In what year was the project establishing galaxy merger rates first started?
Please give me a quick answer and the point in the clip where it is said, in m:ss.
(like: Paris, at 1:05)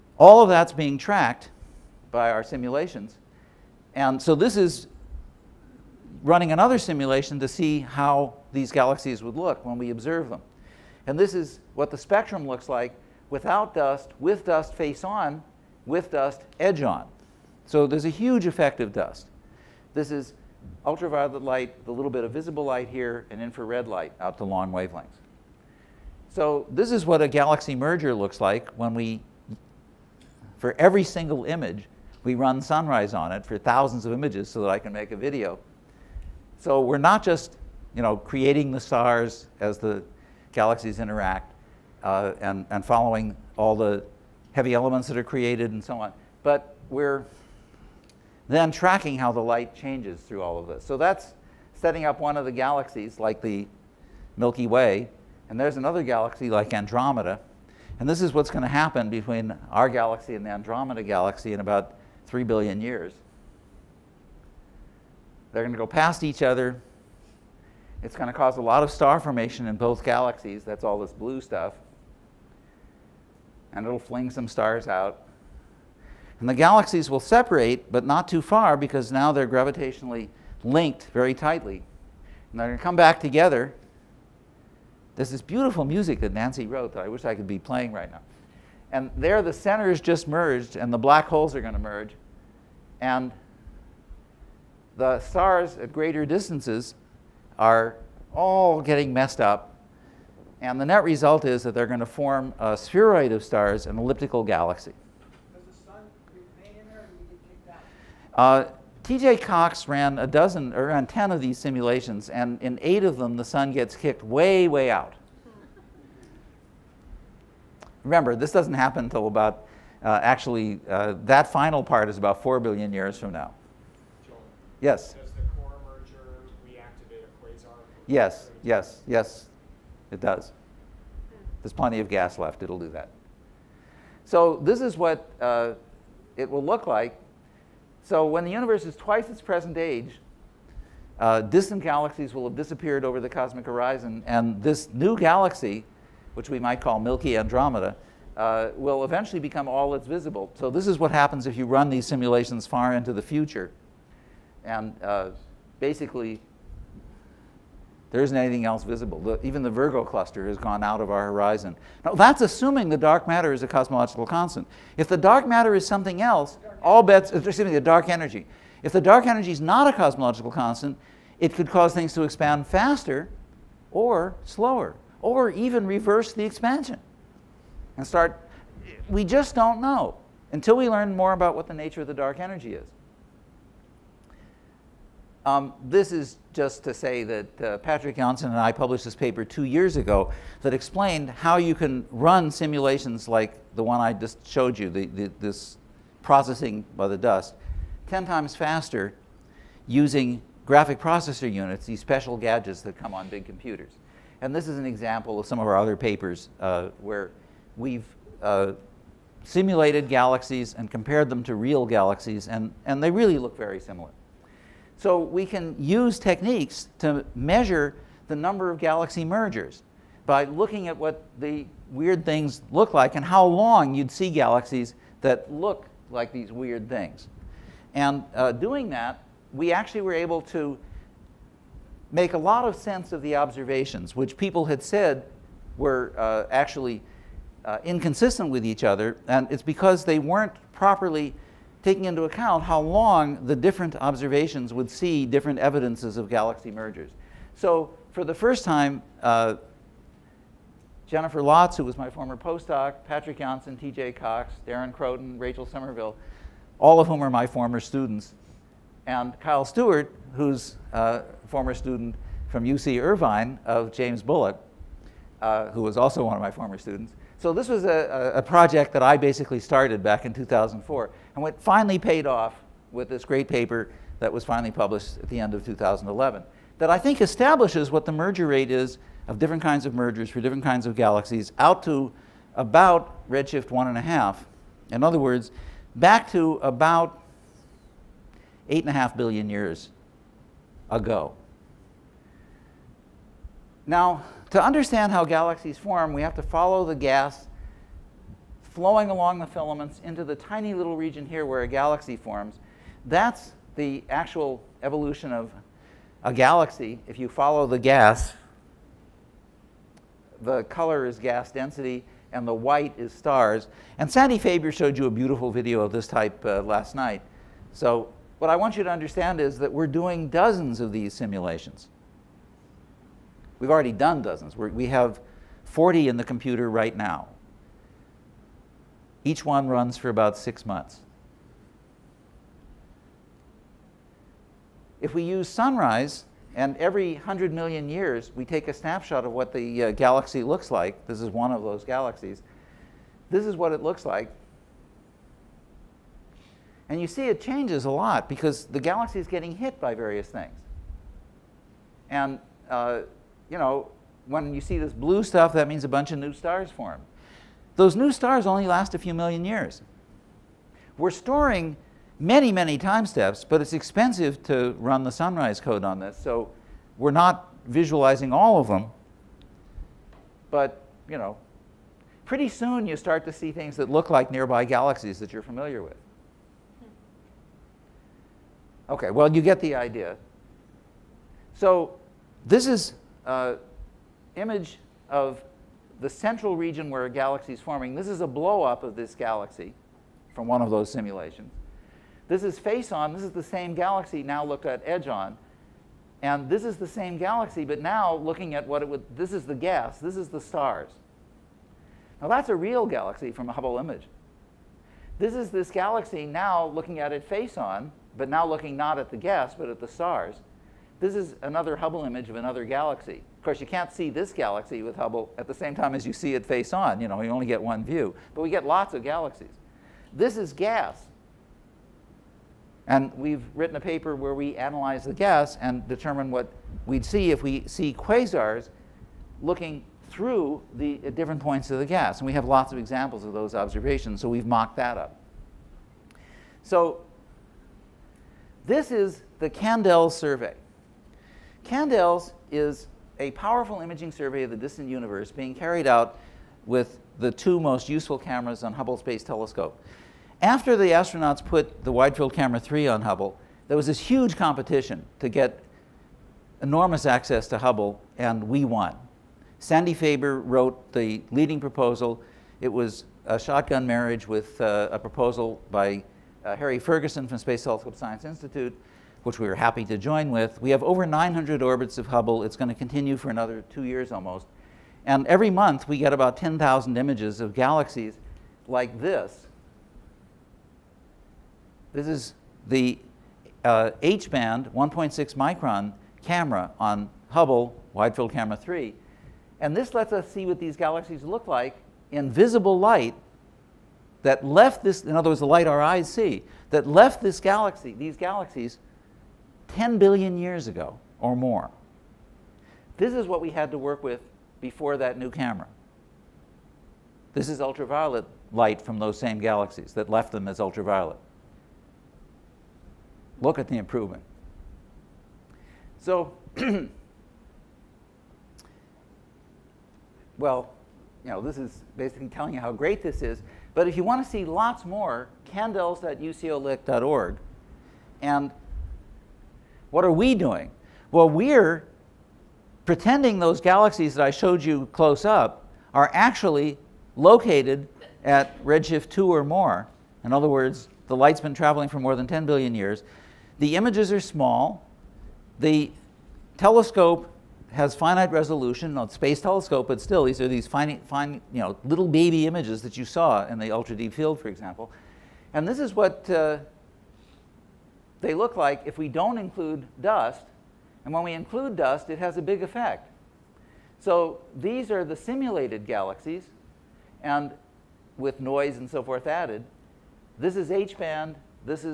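2004, at 4:30.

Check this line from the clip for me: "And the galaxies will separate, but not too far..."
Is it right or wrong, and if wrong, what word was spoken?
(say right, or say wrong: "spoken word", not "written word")
right.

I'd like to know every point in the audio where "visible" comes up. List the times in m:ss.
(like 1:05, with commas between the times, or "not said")
0:22, 2:30, 2:38, 8:12.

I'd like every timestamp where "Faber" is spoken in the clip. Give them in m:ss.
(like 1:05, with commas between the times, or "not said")
5:14, 7:39.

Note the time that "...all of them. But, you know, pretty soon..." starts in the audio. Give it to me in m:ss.
6:08.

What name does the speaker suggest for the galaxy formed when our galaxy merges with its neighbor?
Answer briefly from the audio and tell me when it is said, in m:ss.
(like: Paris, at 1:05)
Milky Andromeda, at 2:26.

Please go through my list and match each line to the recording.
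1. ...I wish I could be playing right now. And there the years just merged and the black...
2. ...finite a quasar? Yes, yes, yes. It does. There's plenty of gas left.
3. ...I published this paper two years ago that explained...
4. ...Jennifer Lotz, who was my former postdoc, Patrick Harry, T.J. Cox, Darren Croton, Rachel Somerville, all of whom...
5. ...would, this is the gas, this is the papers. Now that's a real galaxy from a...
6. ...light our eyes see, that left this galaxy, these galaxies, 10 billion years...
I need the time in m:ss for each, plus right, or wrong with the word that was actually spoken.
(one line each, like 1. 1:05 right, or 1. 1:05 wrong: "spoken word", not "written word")
1. 1:27 wrong: "centers", not "years"
2. 2:06 wrong: "reactivate", not "finite"
3. 3:08 right
4. 4:11 wrong: "Jonsson", not "Harry"
5. 6:38 wrong: "stars", not "papers"
6. 8:15 right.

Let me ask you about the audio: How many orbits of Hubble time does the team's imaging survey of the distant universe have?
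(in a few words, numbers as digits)
over 900.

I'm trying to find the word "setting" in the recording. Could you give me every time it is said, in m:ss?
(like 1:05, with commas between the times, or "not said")
0:51.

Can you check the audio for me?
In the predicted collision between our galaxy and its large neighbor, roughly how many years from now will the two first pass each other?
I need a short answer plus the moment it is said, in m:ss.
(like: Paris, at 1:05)
3 billion years, at 1:02.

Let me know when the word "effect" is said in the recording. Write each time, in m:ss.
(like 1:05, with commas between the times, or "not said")
0:18, 9:22.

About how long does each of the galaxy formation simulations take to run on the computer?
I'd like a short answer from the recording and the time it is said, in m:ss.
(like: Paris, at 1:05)
six months, at 5:30.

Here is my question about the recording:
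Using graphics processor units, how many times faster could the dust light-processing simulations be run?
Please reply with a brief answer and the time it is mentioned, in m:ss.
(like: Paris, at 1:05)
10 times, at 3:18.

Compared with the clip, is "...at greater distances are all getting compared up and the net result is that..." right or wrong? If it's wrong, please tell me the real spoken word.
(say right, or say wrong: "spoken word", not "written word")
wrong: "messed", not "compared".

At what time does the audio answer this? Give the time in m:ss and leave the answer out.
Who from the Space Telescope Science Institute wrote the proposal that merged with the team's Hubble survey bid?
7:46.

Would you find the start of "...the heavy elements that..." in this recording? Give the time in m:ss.
0:43.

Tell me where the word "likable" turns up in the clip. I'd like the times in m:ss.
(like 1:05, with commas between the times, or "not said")
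not said.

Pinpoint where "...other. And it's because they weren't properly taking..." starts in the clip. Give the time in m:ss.
3:58.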